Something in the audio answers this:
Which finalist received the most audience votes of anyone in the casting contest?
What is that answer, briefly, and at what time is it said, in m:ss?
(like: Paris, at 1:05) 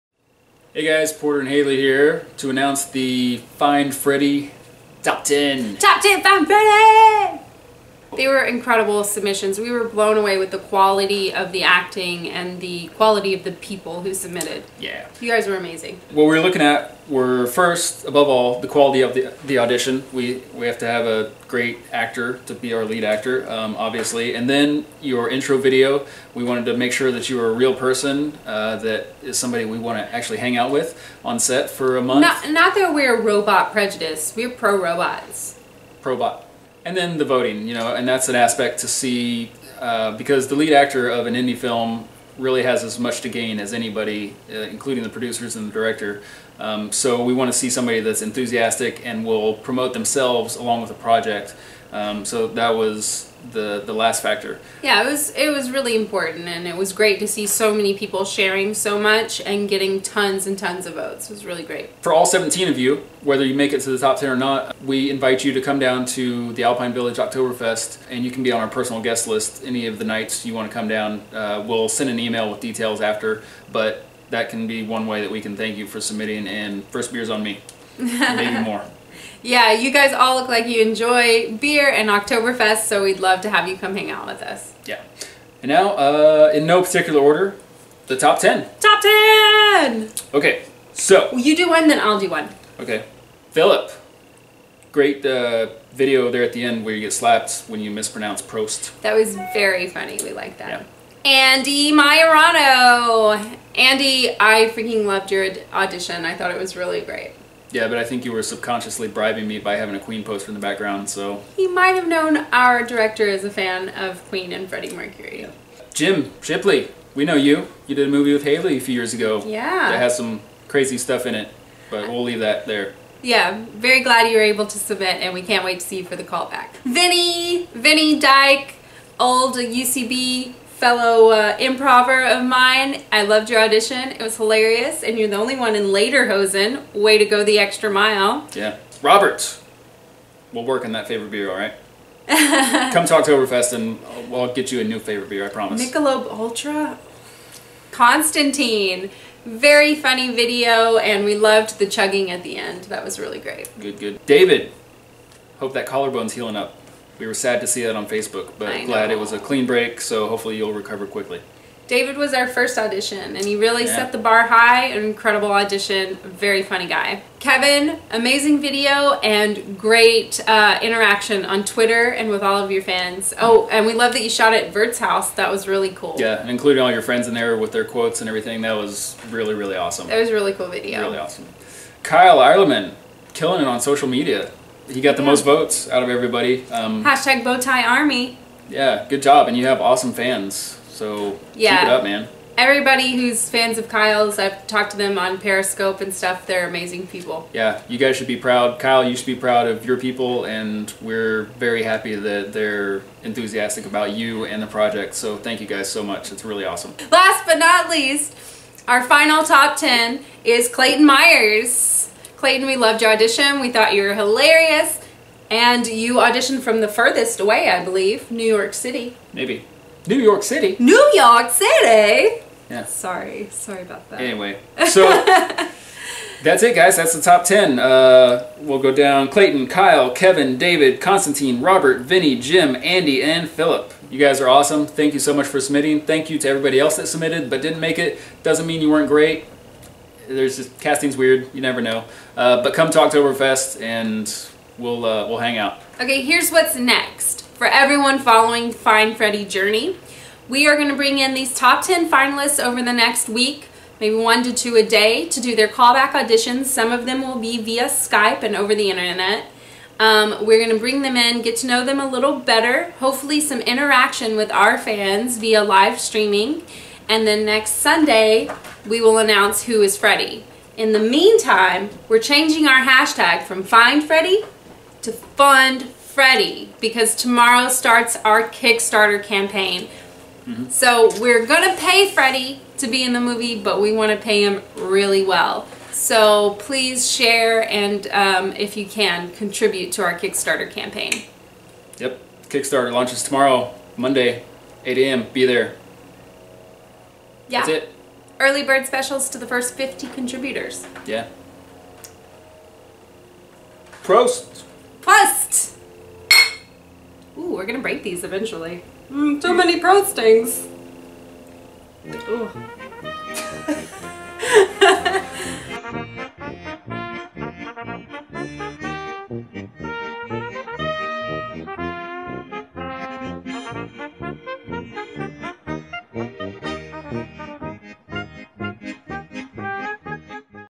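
Kyle Ireland, at 3:02.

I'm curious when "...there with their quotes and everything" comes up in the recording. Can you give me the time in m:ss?
2:57.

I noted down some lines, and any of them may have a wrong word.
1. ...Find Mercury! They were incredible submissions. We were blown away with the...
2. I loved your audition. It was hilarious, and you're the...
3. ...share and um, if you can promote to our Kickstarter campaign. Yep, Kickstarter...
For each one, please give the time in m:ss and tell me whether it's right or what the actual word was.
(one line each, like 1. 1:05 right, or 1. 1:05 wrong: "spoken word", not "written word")
1. 0:06 wrong: "Freddie", not "Mercury"
2. 2:13 right
3. 4:47 wrong: "contribute", not "promote".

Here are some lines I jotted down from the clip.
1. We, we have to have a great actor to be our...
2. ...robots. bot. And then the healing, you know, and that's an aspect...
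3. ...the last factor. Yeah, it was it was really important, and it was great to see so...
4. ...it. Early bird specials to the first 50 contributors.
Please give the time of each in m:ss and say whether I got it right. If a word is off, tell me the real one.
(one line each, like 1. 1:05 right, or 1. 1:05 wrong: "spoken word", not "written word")
1. 0:20 right
2. 0:34 wrong: "voting", not "healing"
3. 0:53 right
4. 4:57 right.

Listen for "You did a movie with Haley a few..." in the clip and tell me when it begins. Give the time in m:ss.
1:57.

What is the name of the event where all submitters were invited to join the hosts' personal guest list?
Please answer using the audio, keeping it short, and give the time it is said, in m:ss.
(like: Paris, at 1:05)
Alpine Village Oktoberfest, at 1:06.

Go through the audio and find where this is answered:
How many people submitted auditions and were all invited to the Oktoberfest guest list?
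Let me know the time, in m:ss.
1:02.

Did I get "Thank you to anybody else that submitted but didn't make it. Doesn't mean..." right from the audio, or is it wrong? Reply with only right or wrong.
wrong.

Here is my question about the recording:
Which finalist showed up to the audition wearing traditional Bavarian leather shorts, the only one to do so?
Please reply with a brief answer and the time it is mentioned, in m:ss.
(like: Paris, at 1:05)
Vinny Dyke, at 2:07.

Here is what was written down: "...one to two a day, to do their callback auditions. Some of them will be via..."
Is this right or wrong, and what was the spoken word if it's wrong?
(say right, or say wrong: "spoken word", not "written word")
right.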